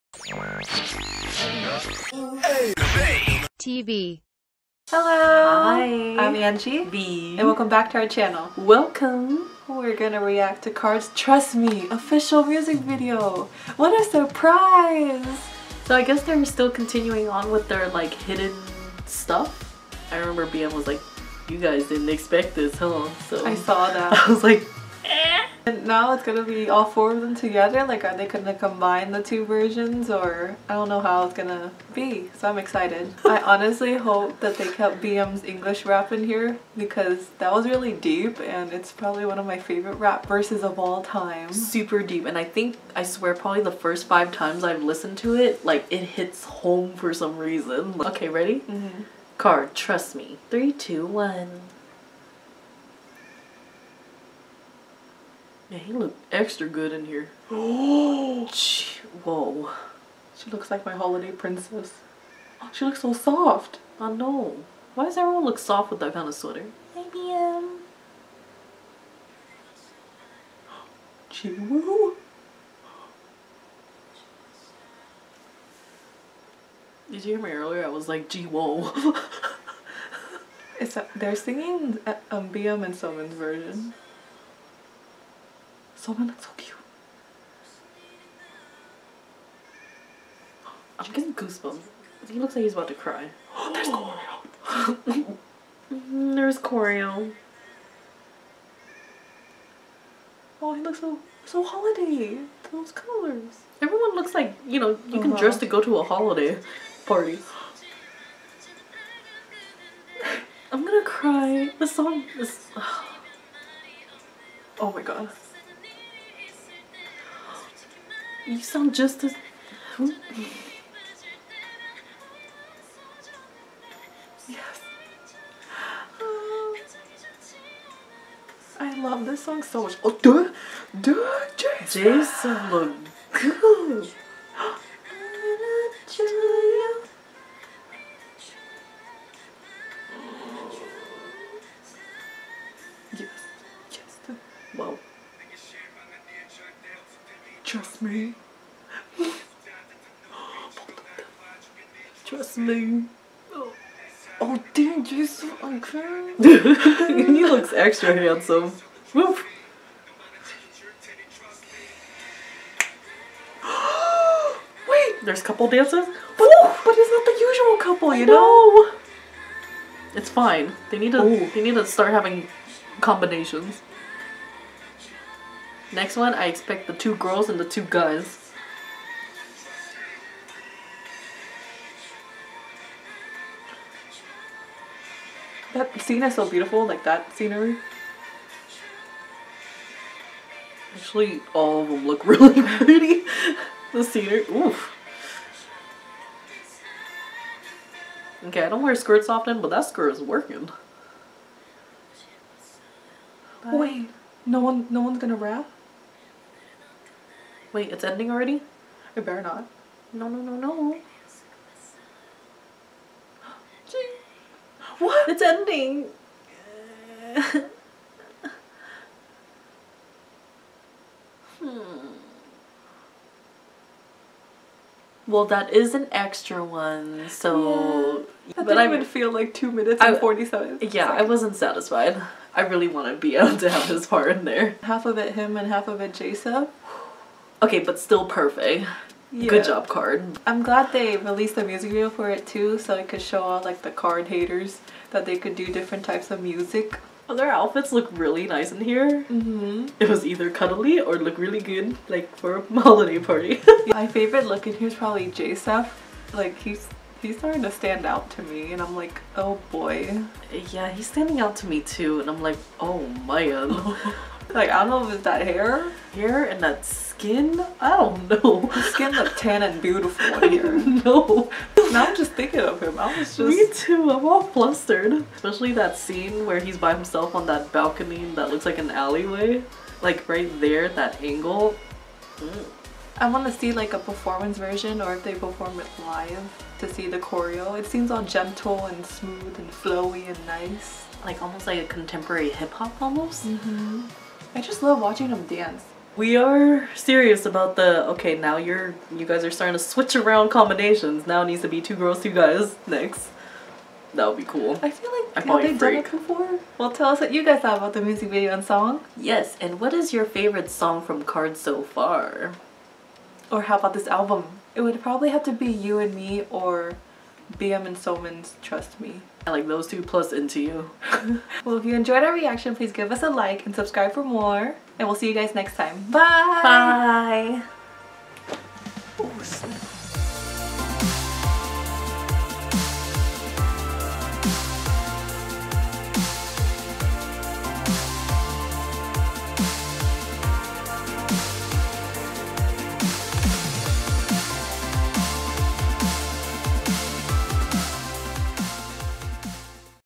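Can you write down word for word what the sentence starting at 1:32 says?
He looks like he's about to cry.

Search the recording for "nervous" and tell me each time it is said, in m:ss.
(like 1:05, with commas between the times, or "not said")
not said.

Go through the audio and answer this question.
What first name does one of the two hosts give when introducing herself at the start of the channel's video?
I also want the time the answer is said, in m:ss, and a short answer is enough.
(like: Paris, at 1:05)
Angie, at 0:06.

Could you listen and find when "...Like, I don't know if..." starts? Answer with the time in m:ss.
4:24.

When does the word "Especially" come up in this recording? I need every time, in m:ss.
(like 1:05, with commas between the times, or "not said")
4:35.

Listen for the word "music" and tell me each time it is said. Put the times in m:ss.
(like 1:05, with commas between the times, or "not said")
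0:12, 4:01, 4:06, 5:08.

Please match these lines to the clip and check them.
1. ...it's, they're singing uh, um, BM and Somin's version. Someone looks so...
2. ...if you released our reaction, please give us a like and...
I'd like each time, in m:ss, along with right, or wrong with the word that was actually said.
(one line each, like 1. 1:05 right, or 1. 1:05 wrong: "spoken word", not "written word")
1. 1:20 right
2. 5:21 wrong: "enjoyed", not "released".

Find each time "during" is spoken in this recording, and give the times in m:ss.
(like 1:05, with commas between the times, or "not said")
not said.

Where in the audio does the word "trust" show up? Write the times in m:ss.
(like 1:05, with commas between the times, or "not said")
0:11, 0:49, 2:28, 2:32, 5:18.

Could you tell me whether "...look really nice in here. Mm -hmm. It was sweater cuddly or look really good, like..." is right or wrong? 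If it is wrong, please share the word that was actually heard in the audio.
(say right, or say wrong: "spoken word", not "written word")
wrong: "either", not "sweater".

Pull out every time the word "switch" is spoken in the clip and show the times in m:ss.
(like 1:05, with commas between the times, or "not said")
4:59.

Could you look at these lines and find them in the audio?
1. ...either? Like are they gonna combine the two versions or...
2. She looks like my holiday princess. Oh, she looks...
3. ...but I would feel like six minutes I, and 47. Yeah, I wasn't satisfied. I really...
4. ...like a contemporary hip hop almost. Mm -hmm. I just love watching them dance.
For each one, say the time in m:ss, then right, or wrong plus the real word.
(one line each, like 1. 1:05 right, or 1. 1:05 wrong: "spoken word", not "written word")
1. 0:27 wrong: "together", not "either"
2. 1:00 right
3. 3:48 wrong: "two", not "six"
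4. 4:51 right.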